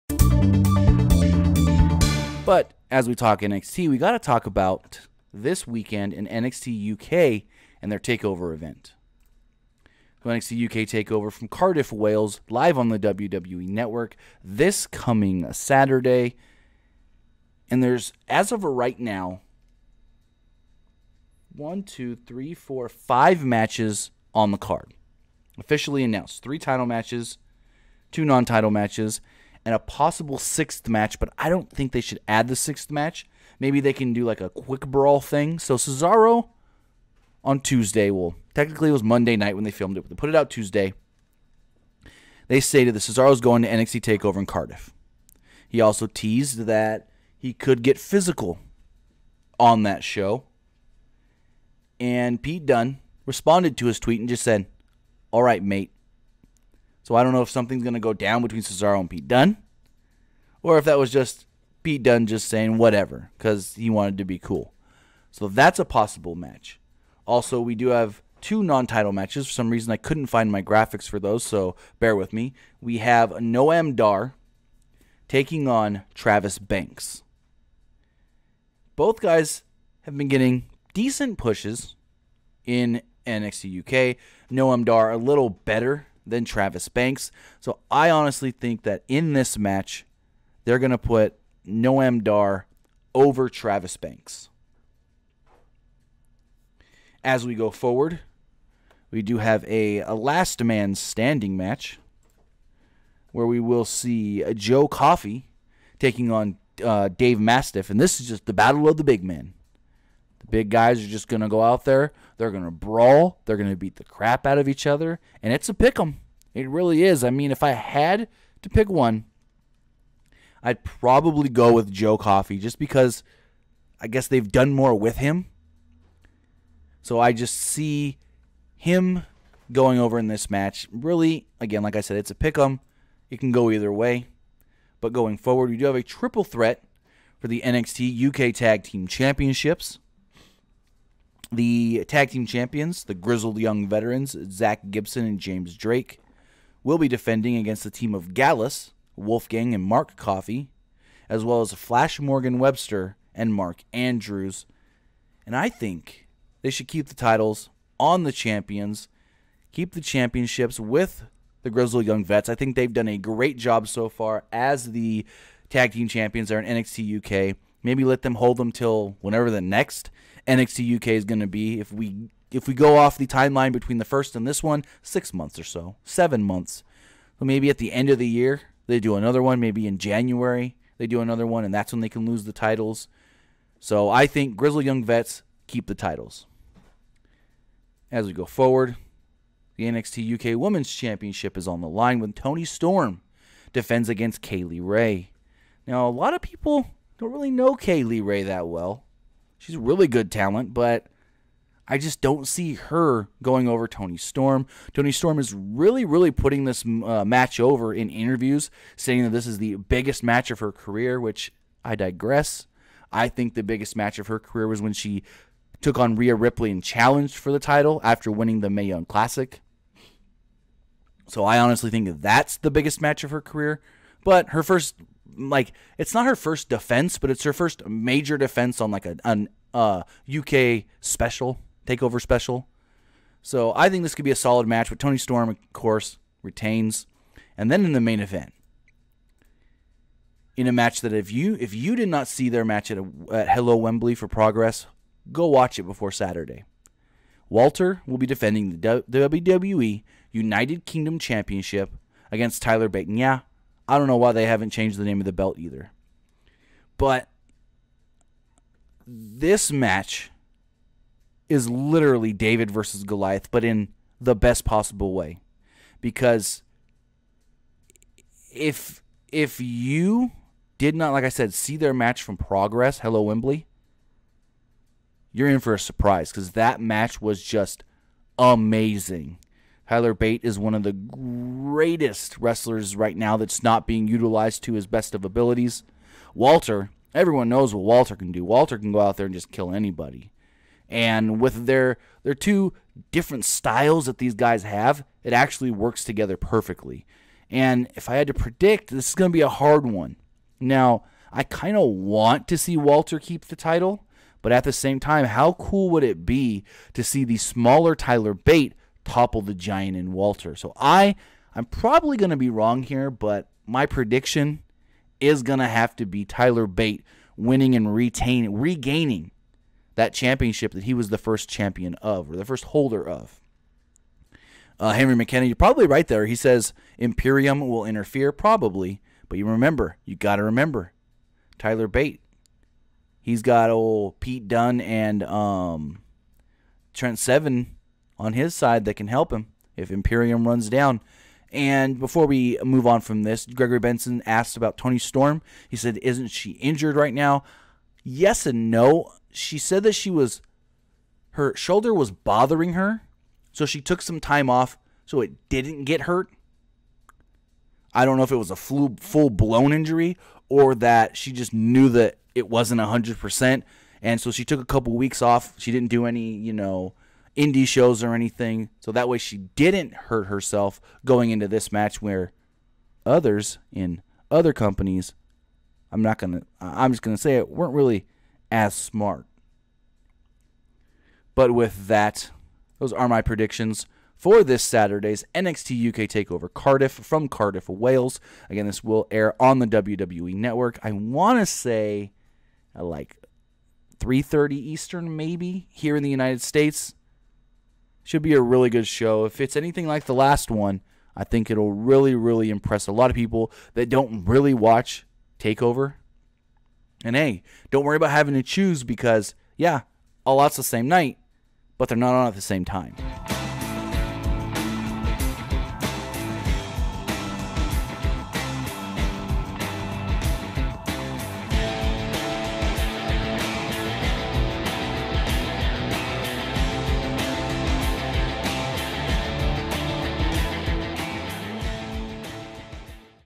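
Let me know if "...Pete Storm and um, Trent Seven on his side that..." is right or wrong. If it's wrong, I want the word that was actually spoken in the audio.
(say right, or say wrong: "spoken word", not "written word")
wrong: "Dunne", not "Storm".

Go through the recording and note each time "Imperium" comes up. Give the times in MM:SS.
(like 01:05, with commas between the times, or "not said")
05:26, 05:39.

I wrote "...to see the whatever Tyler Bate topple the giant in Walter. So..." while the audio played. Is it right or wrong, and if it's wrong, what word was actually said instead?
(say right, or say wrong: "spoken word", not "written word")
wrong: "smaller", not "whatever".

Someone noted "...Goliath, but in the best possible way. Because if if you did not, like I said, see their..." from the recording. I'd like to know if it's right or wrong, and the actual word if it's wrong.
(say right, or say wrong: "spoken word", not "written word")
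right.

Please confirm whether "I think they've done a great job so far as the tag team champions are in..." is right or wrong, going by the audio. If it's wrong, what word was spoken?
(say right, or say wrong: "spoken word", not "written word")
right.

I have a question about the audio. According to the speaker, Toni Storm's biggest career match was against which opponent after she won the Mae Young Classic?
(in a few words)
Rhea Ripley.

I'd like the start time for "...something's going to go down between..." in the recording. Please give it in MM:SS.
00:57.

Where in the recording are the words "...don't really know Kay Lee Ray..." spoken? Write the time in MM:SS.
03:17.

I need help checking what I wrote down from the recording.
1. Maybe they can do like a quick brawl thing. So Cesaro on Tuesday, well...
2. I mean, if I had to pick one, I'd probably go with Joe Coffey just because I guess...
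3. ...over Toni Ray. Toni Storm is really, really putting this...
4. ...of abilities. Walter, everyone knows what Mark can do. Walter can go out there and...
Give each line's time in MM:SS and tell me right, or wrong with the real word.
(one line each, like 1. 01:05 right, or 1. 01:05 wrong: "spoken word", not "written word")
1. 00:33 right
2. 01:57 right
3. 03:23 wrong: "Storm", not "Ray"
4. 04:45 wrong: "Walter", not "Mark".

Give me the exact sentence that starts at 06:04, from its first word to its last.
And so she took a couple weeks off.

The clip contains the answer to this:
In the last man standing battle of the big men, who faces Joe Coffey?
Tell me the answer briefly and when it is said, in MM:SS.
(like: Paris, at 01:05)
Dave Mastiff, at 01:47.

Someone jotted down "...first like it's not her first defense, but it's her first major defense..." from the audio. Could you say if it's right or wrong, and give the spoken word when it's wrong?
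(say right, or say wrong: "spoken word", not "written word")
right.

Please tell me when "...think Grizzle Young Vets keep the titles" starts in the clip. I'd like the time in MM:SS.
03:04.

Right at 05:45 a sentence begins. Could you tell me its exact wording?
He said, Isn't she injured right now?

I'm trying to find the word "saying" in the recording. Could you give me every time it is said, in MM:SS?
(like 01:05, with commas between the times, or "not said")
01:02, 03:28.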